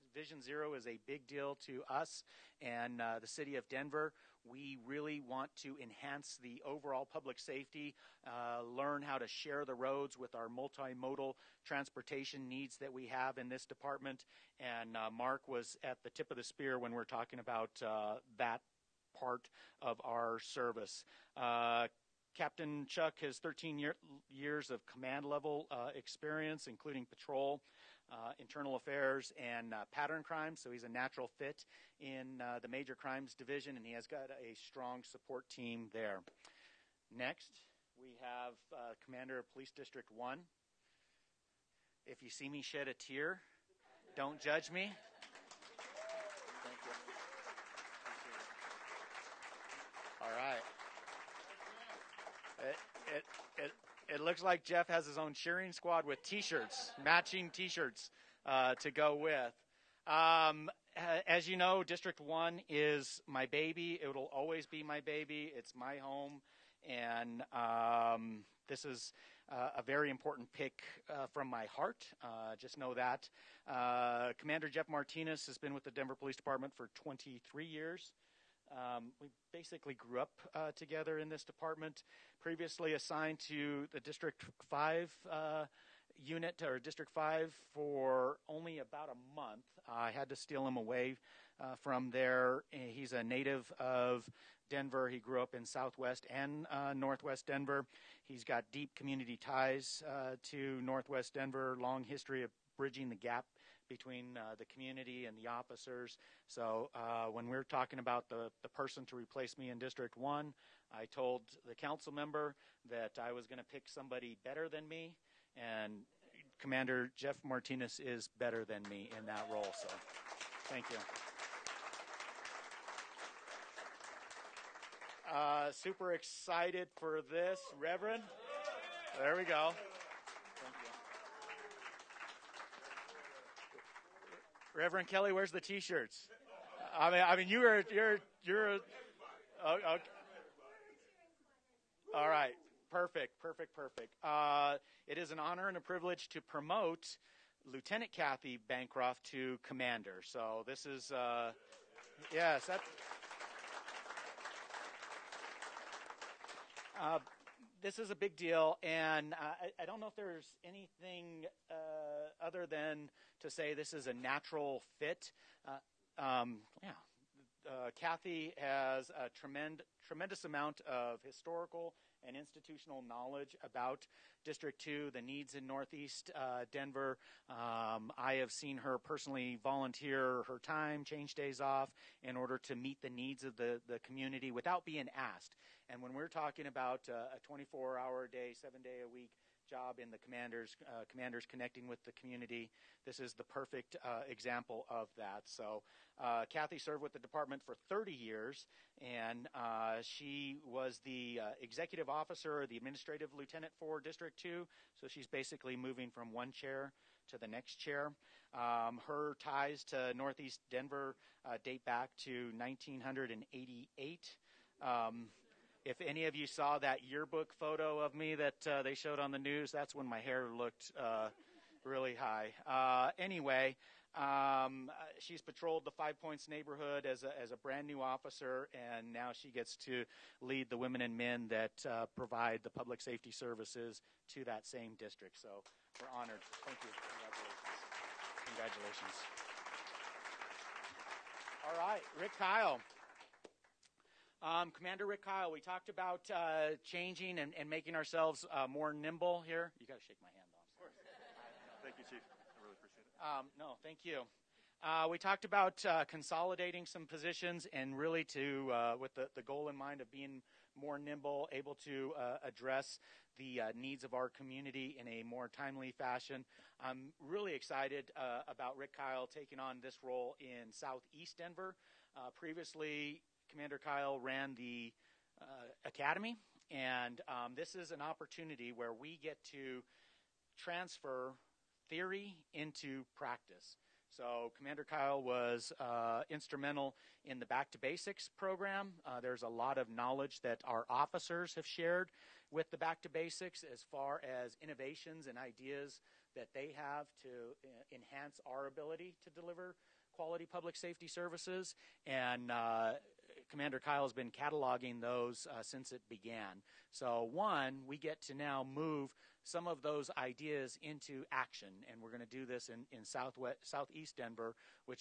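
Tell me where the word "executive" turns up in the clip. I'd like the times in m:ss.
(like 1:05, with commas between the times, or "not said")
3:21.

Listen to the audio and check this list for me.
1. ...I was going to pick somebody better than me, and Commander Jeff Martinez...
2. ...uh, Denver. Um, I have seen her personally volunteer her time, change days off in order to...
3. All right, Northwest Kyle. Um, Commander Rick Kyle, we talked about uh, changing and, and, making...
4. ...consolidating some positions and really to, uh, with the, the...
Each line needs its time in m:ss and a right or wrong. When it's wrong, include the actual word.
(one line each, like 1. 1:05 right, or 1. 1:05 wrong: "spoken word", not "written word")
1. 1:53 right
2. 2:56 right
3. 4:01 wrong: "Rick", not "Northwest"
4. 4:16 right.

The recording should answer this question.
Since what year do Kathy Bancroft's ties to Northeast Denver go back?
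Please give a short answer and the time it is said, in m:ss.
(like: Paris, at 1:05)
1988, at 3:32.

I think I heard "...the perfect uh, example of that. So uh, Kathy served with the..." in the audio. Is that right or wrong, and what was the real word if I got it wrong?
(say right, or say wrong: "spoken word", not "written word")
right.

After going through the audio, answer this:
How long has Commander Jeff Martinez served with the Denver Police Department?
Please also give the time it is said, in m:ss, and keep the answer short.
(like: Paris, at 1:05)
23 years, at 1:16.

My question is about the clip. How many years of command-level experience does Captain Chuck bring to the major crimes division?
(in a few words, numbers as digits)
13.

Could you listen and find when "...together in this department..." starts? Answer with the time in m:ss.
1:20.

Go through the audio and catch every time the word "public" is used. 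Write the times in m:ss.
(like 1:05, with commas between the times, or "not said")
0:07, 3:52, 5:00.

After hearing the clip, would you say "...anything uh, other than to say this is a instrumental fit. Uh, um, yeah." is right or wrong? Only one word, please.
wrong.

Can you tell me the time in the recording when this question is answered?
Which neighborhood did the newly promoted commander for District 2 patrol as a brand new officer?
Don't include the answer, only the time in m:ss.
3:45.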